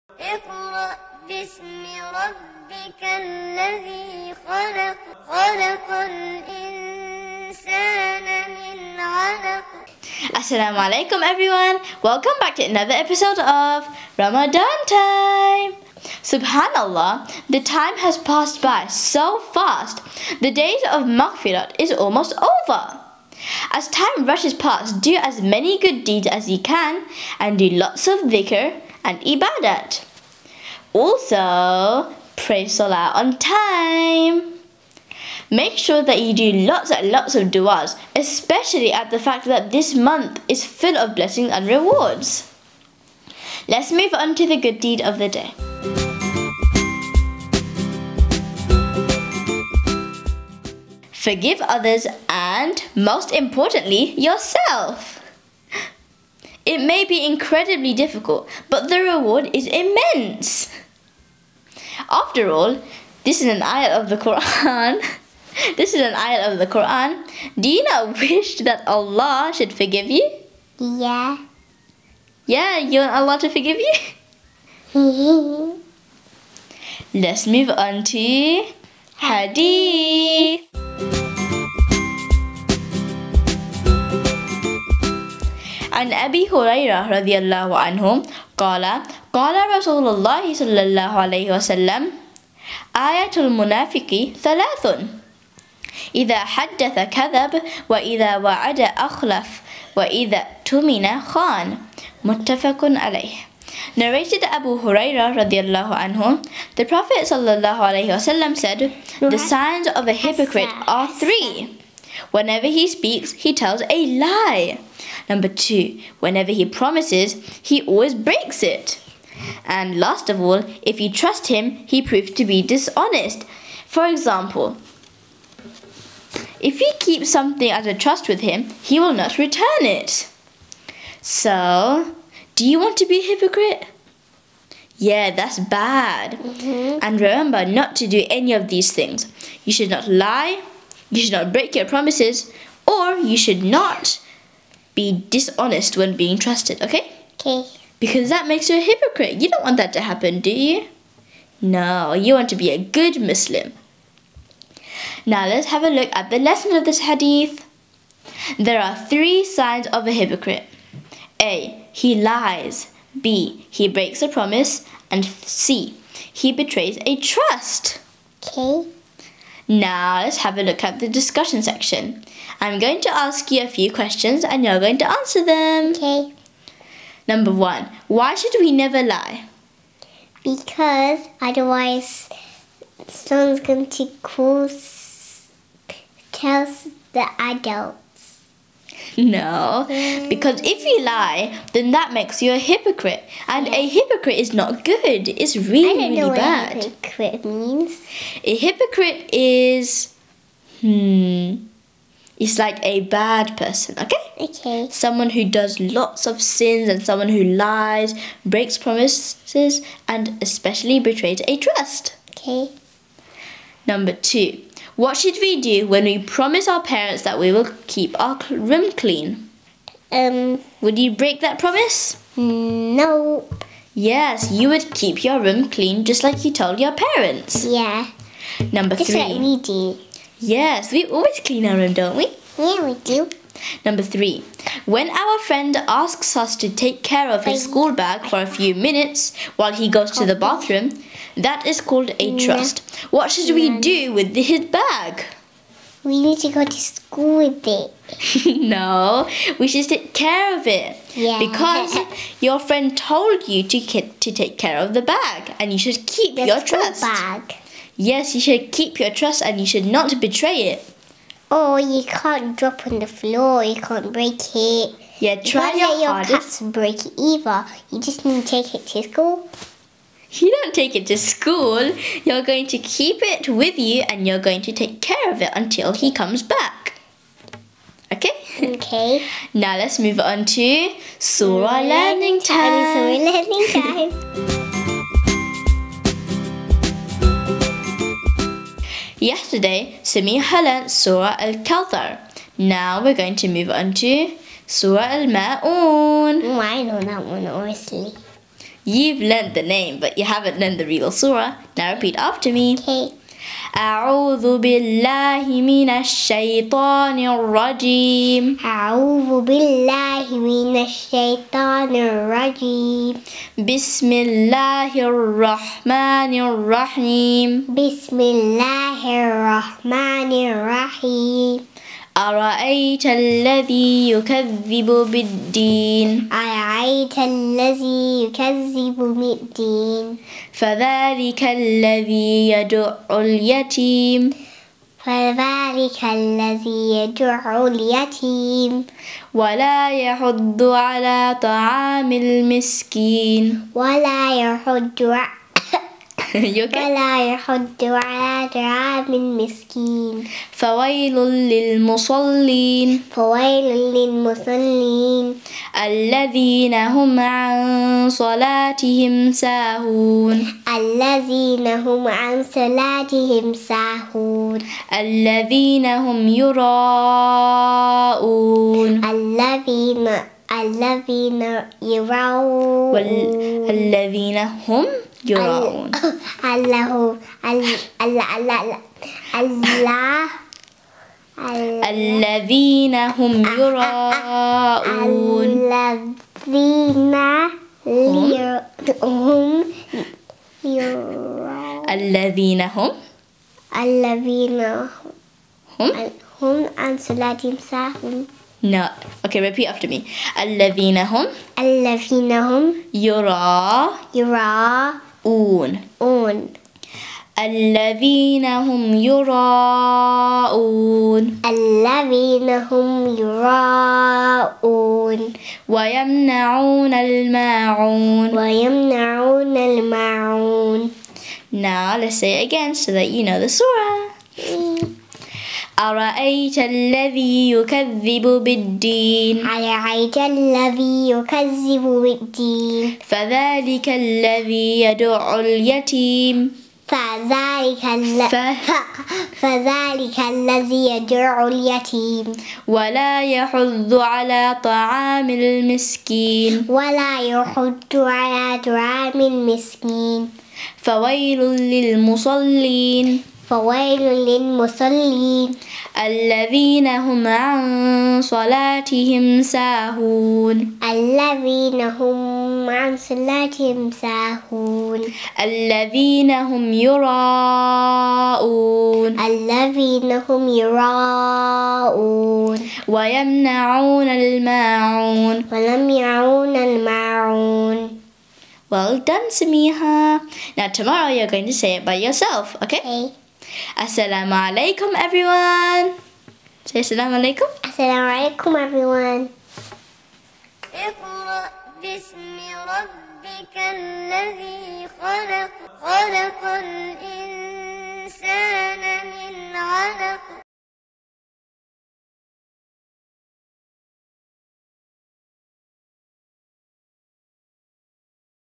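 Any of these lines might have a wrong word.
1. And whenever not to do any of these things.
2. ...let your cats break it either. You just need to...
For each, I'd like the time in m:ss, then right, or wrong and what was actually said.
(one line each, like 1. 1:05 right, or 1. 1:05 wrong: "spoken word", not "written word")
1. 2:17 wrong: "remember", not "whenever"
2. 4:26 right.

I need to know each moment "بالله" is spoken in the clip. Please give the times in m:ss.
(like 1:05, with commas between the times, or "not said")
5:04, 5:09.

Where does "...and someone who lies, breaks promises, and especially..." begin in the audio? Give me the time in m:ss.
3:26.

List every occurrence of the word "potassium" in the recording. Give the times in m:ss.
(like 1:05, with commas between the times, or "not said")
not said.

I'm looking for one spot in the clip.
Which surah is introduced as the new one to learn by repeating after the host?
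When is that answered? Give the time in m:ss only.
4:54.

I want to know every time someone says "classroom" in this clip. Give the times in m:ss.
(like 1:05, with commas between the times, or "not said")
not said.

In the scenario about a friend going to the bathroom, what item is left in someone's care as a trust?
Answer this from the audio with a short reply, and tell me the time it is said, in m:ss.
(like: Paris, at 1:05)
School bag, at 3:57.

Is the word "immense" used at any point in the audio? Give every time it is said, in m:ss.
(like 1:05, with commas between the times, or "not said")
0:59.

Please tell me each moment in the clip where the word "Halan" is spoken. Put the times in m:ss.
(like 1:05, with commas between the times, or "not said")
4:50.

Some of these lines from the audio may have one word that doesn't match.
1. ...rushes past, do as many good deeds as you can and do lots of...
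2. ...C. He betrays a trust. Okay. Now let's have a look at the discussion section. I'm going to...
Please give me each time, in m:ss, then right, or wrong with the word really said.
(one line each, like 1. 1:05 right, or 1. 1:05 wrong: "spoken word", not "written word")
1. 0:24 right
2. 2:45 right.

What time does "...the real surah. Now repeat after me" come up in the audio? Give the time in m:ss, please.
5:00.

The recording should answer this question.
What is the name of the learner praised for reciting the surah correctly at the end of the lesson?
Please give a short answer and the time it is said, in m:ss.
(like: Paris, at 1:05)
Samiha, at 7:59.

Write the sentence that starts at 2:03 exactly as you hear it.
For example, if you keep something as a trust with him, he will not return it.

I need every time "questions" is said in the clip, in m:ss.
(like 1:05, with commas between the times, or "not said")
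2:53.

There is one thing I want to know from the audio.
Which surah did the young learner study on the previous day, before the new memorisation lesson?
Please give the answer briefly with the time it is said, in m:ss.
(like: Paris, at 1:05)
Surah Al-Kawthar, at 4:50.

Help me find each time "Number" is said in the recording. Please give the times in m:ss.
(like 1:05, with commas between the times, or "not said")
1:55, 2:57, 3:33, 3:48, 3:53.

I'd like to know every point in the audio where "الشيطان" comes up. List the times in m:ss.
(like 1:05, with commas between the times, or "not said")
5:05, 5:10.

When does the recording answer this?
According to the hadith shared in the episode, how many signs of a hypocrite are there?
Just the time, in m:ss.
1:49.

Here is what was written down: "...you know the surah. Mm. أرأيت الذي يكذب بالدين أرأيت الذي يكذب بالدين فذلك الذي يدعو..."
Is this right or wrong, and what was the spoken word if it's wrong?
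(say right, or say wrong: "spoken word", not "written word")
right.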